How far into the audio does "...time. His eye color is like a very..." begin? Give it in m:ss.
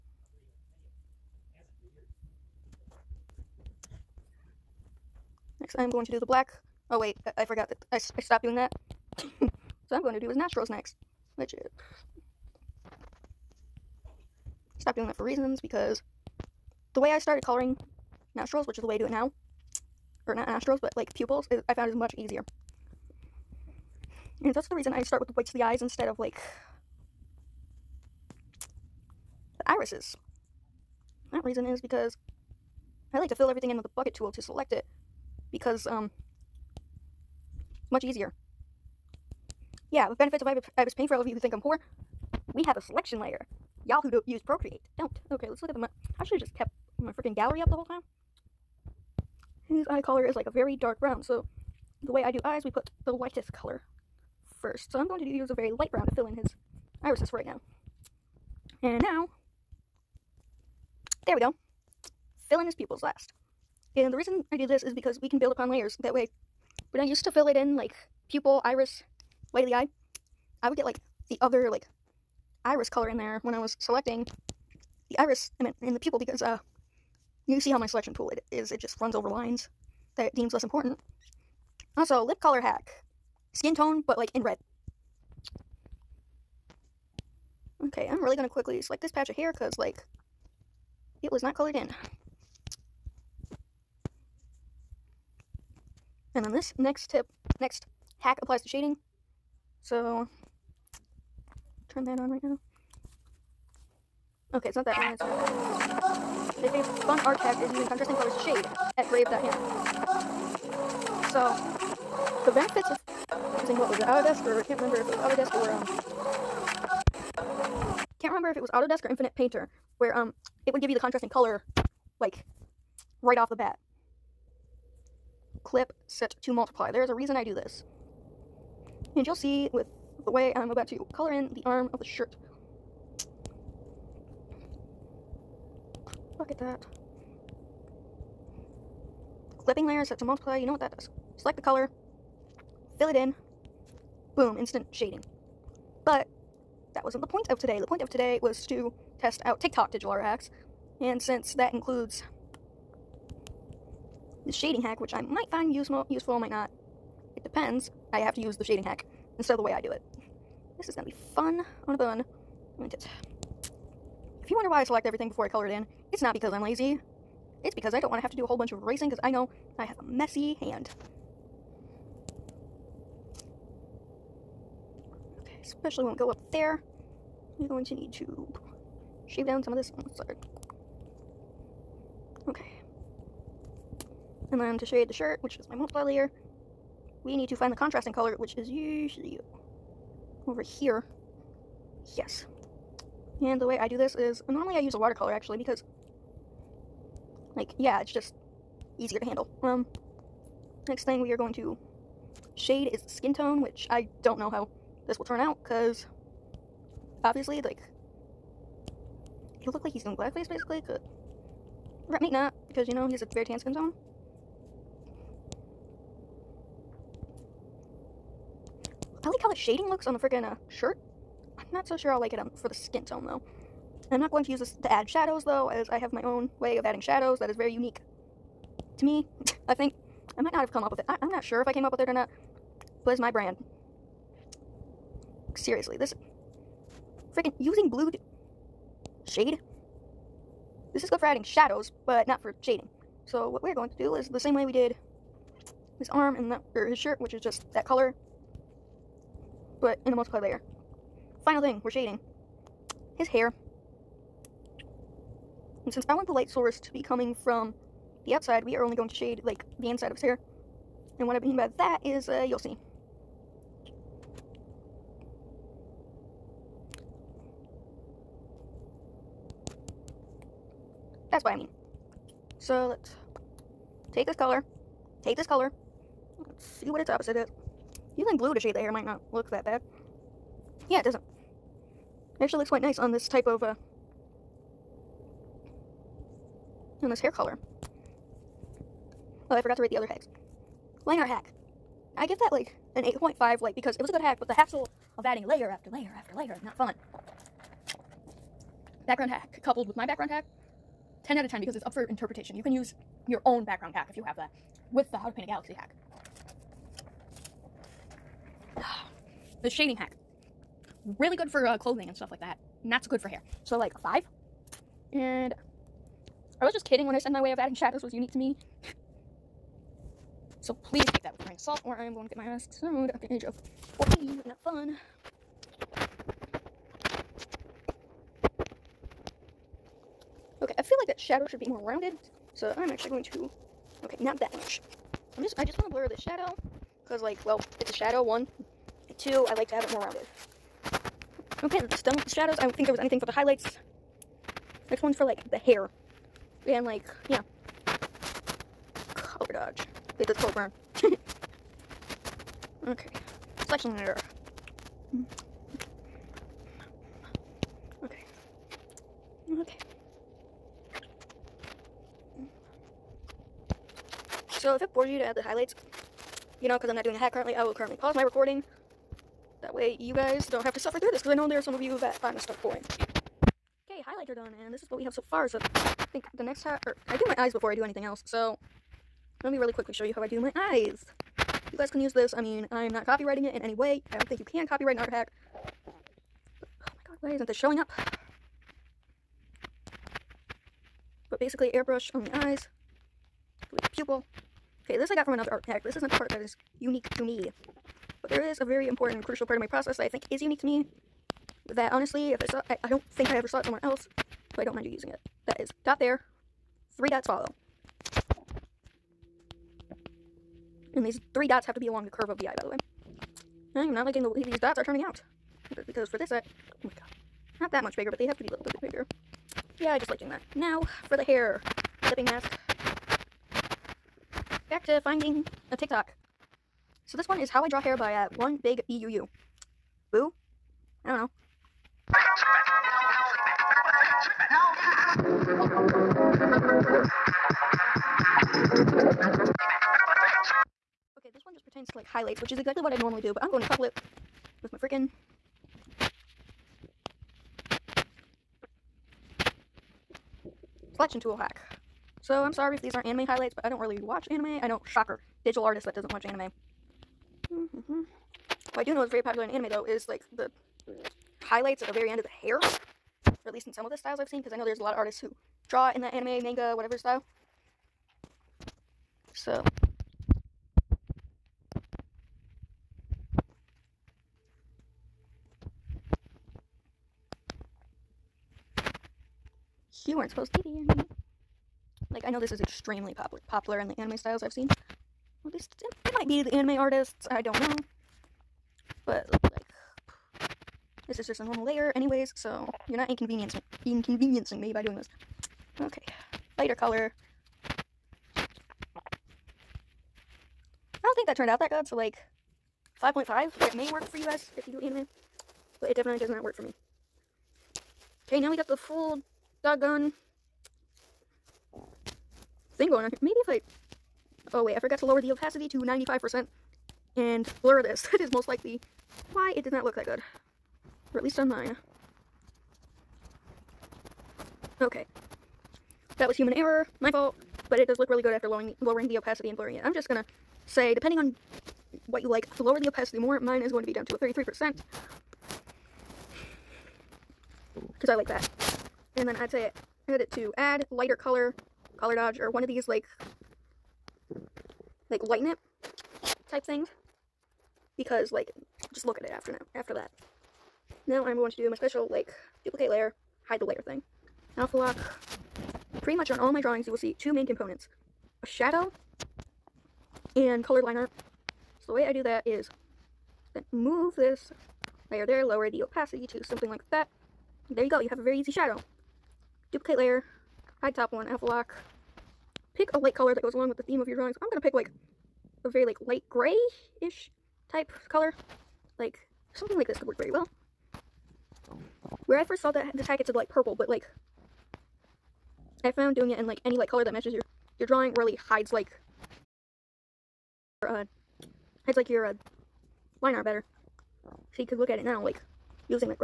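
0:47.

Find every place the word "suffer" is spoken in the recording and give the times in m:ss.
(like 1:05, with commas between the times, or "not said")
6:10.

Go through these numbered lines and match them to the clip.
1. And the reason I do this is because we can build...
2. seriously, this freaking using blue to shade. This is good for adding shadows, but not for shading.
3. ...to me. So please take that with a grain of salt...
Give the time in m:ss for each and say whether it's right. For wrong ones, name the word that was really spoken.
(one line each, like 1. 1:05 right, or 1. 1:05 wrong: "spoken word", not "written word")
1. 1:03 right
2. 3:55 right
3. 5:18 right.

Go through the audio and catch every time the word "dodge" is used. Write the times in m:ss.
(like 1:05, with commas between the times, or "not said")
5:49, 9:02.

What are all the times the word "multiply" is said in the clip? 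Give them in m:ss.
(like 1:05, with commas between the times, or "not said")
2:06, 2:20, 3:05, 4:10.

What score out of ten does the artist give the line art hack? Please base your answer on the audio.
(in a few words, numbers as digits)
8.5.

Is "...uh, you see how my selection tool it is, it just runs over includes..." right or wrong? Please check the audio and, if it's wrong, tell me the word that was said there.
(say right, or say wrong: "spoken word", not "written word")
wrong: "lines", not "includes".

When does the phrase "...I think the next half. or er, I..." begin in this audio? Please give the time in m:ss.
6:15.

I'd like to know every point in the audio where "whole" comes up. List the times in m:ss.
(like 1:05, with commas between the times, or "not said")
0:47, 2:48.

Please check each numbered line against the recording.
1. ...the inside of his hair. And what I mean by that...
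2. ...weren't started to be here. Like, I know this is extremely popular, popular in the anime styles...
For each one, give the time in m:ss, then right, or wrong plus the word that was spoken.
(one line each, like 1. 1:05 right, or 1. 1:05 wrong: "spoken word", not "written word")
1. 4:19 right
2. 8:00 wrong: "supposed", not "started".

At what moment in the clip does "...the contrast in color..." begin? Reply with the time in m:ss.
2:00.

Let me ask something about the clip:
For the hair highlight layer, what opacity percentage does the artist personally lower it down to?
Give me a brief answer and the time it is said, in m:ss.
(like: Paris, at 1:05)
33%, at 8:54.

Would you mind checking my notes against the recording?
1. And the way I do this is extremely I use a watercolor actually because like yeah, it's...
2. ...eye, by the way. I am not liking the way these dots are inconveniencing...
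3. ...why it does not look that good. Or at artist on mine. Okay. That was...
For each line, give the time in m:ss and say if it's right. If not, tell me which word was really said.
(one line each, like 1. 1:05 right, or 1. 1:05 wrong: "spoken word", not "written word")
1. 3:13 wrong: "normally", not "extremely"
2. 6:52 wrong: "turning", not "inconveniencing"
3. 8:39 wrong: "least", not "artist".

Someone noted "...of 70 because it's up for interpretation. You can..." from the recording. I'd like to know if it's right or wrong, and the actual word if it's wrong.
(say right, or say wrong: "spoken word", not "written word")
wrong: "10", not "70".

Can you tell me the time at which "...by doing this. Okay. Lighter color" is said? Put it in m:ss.
8:14.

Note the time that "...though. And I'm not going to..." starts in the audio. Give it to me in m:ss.
3:43.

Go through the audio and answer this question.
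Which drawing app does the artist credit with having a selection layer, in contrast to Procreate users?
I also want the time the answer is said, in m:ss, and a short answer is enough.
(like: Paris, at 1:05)
Ibis Paint, at 0:40.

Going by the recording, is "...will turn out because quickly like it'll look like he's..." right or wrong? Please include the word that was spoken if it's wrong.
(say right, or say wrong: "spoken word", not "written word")
wrong: "obviously", not "quickly".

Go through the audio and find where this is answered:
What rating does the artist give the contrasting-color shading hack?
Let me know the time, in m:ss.
5:13.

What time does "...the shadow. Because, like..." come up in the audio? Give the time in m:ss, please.
5:36.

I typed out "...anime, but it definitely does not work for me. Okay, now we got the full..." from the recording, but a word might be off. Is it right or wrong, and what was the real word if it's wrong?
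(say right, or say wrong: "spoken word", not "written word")
right.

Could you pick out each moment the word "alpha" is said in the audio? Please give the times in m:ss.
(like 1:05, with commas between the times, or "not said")
9:14, 9:31.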